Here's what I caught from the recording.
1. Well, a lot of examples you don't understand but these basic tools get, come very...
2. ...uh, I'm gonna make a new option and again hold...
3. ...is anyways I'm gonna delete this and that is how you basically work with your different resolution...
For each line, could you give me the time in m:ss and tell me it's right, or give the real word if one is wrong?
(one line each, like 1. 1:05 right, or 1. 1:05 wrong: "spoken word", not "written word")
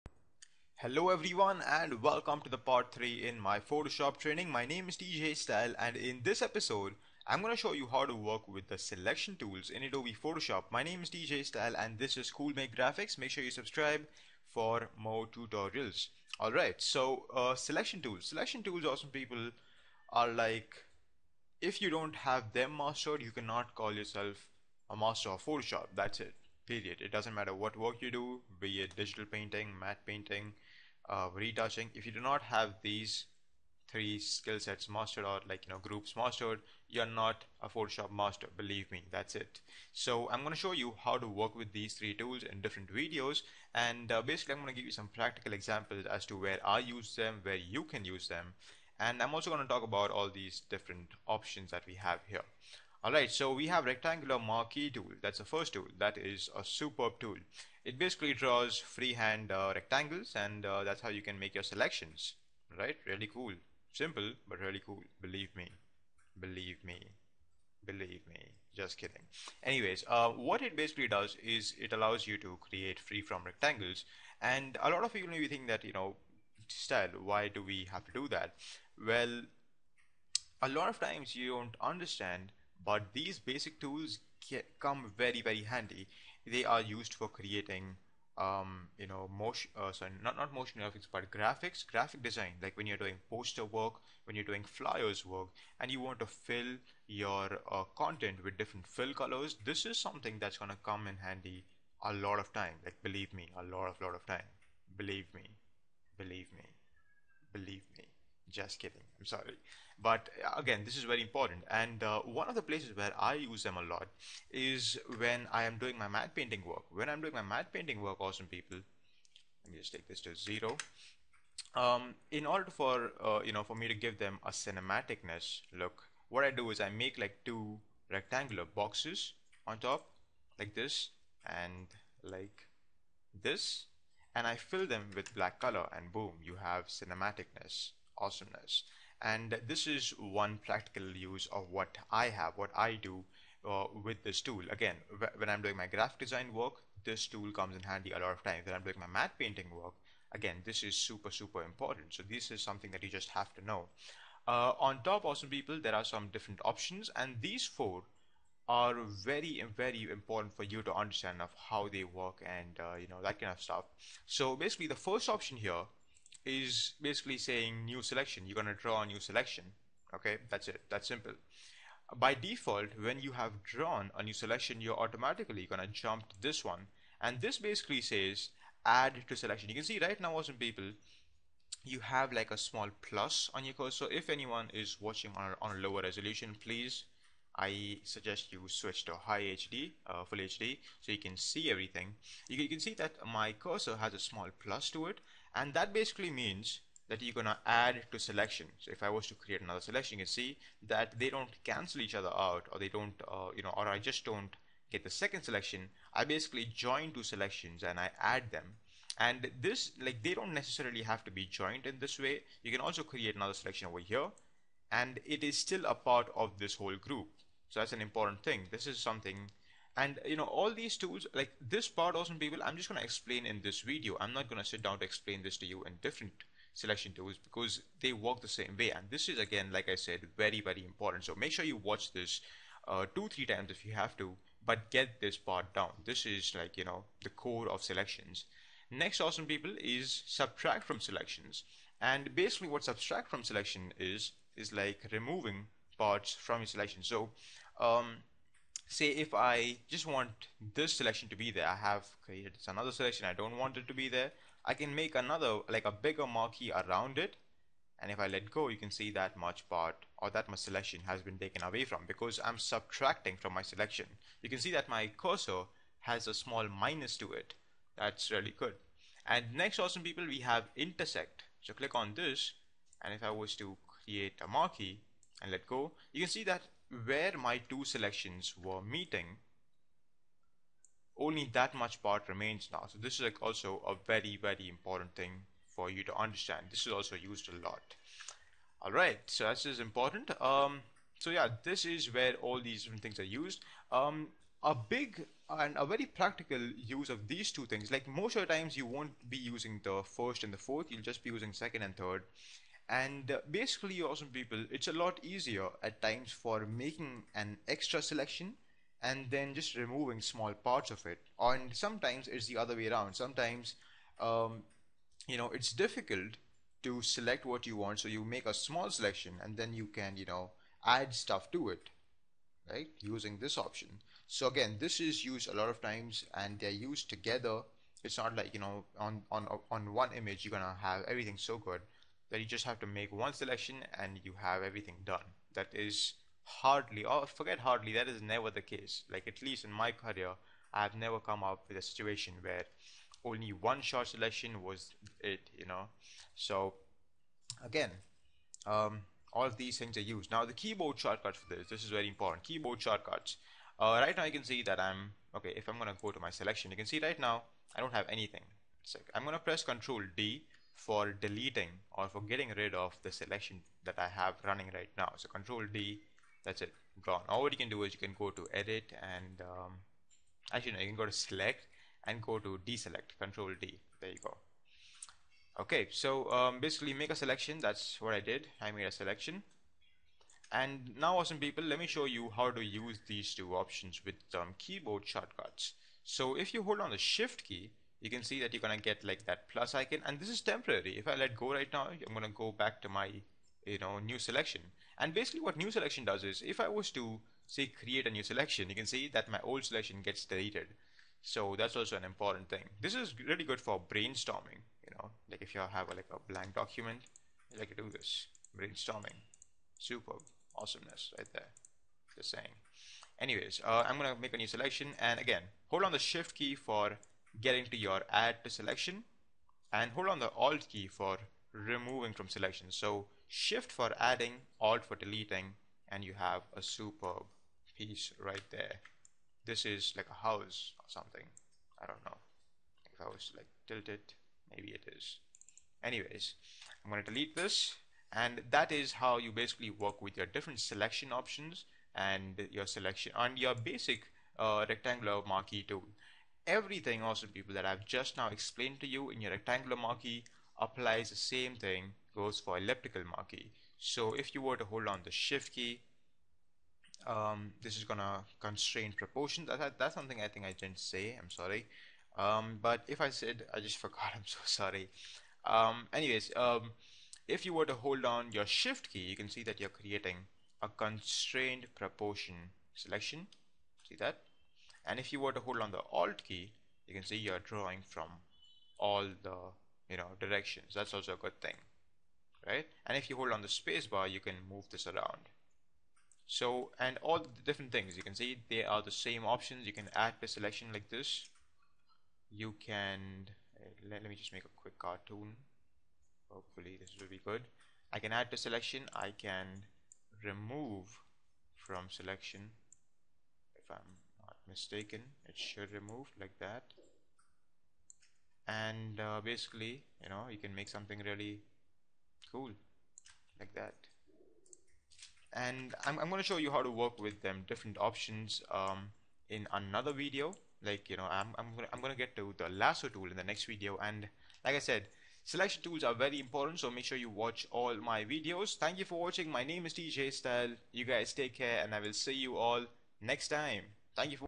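1. 1:19 wrong: "times", not "examples"
2. 6:53 wrong: "selection", not "option"
3. 7:14 wrong: "selection", not "resolution".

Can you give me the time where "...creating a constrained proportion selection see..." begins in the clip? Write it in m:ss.
7:49.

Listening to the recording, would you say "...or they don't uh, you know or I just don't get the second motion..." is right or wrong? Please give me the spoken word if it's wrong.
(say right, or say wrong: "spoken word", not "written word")
wrong: "selection", not "motion".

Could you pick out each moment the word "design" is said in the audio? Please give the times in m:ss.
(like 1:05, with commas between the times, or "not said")
1:32, 2:26.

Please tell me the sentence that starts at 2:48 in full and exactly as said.
You're going to draw a new selection.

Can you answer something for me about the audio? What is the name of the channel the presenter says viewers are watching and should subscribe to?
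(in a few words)
Cool Make Graphics.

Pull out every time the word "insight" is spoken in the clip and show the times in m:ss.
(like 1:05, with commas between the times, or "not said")
not said.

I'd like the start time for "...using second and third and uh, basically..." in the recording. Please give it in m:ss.
5:01.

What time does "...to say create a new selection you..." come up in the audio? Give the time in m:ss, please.
6:36.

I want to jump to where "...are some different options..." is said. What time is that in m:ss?
2:35.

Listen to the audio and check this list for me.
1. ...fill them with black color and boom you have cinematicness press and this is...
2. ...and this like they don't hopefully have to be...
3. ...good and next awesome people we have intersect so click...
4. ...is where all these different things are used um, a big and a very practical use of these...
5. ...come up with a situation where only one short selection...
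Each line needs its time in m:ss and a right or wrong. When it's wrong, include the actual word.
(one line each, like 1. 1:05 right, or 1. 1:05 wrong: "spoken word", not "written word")
1. 2:14 wrong: "awesomeness", not "press"
2. 3:29 wrong: "necessarily", not "hopefully"
3. 4:28 right
4. 4:51 right
5. 5:41 right.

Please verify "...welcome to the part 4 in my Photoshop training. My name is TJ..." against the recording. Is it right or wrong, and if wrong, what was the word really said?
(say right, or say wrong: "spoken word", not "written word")
wrong: "3", not "4".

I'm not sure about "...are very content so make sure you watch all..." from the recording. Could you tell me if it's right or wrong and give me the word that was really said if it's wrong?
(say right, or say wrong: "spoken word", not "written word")
wrong: "important", not "content".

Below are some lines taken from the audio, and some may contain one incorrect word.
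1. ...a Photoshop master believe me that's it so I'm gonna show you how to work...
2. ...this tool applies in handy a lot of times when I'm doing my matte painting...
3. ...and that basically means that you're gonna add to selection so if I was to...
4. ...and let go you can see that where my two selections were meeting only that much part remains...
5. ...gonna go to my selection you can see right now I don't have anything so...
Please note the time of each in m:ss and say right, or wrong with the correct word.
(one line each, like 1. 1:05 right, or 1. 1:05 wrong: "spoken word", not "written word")
1. 0:37 right
2. 2:27 wrong: "comes", not "applies"
3. 3:15 right
4. 4:35 right
5. 5:55 right.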